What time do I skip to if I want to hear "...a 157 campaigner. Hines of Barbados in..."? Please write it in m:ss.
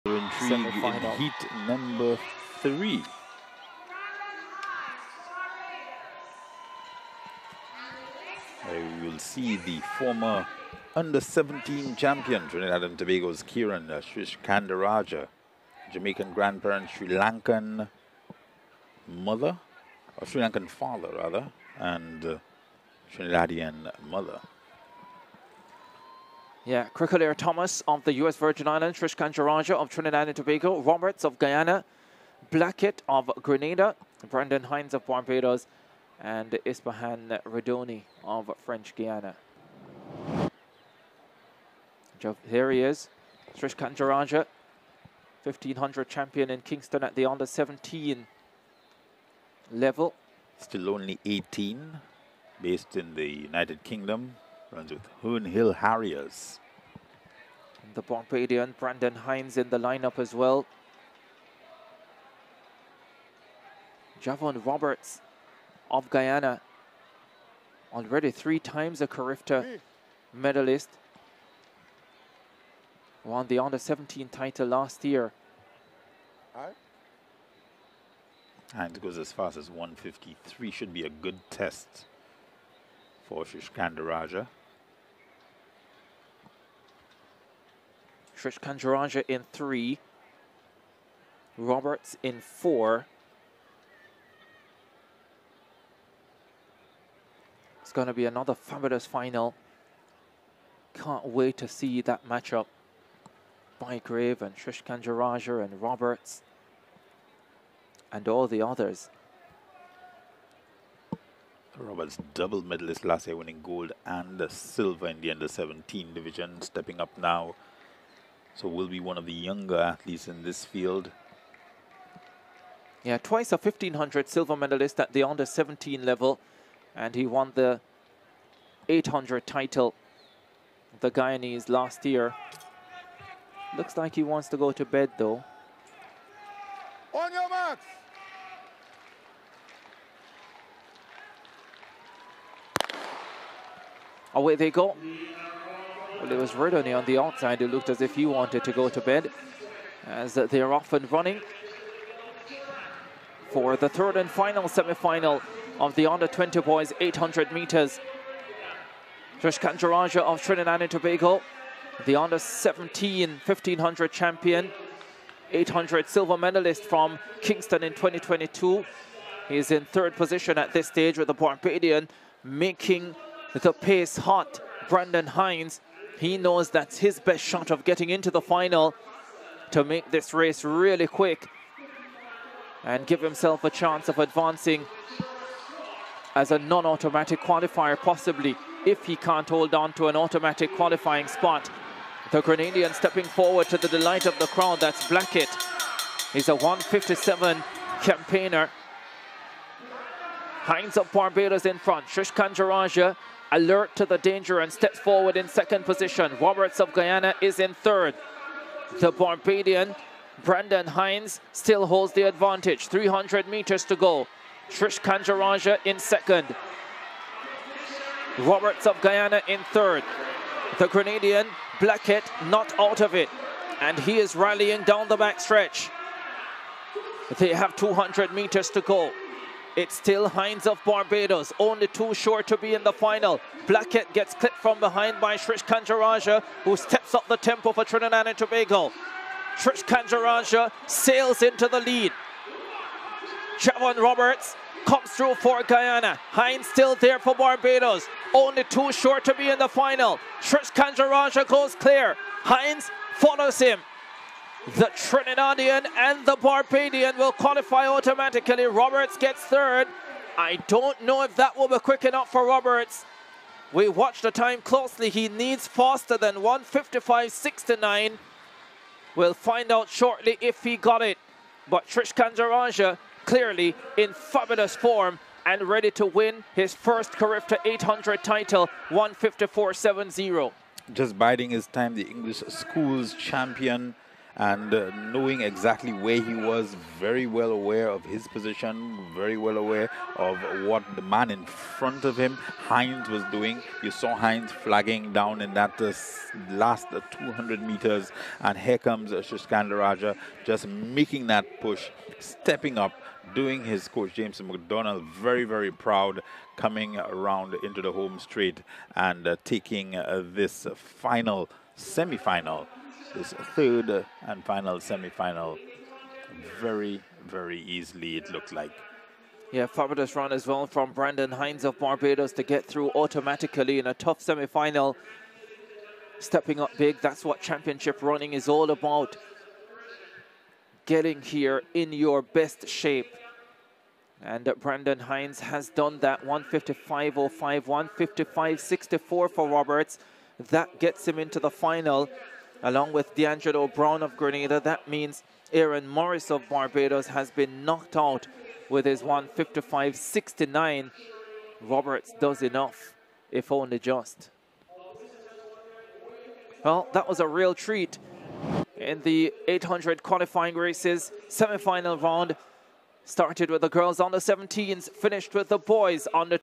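3:16.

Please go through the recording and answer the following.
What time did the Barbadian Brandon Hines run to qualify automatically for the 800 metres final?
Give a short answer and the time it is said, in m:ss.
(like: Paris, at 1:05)
1:55.05, at 5:36.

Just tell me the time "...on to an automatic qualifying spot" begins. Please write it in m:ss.
3:09.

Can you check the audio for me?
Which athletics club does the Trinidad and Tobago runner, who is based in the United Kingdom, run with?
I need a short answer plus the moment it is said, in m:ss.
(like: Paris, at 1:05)
Herne Hill Harriers, at 0:55.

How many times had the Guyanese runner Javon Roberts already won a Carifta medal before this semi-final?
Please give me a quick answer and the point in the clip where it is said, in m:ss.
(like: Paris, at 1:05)
3, at 1:08.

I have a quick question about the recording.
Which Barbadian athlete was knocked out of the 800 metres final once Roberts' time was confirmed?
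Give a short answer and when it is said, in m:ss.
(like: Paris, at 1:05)
Aaron Morris, at 5:45.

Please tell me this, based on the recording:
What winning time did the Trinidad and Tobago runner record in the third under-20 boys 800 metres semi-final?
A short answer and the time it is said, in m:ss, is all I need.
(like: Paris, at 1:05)
1:54.70, at 4:38.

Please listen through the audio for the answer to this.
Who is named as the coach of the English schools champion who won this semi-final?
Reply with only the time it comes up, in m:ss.
5:04.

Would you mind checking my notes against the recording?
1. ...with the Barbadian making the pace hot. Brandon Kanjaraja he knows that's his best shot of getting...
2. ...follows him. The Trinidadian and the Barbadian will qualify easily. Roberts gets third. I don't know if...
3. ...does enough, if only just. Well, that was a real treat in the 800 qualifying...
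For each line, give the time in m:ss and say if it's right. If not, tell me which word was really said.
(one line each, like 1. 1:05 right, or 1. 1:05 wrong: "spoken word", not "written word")
1. 2:51 wrong: "Hines", not "Kanjaraja"
2. 4:13 wrong: "automatically", not "easily"
3. 5:52 right.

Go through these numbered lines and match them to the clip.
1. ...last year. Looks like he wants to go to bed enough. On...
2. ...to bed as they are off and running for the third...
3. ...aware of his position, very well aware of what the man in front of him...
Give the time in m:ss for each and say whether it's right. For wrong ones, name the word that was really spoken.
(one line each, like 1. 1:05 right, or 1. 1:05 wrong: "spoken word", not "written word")
1. 2:11 wrong: "though", not "enough"
2. 2:28 right
3. 4:47 right.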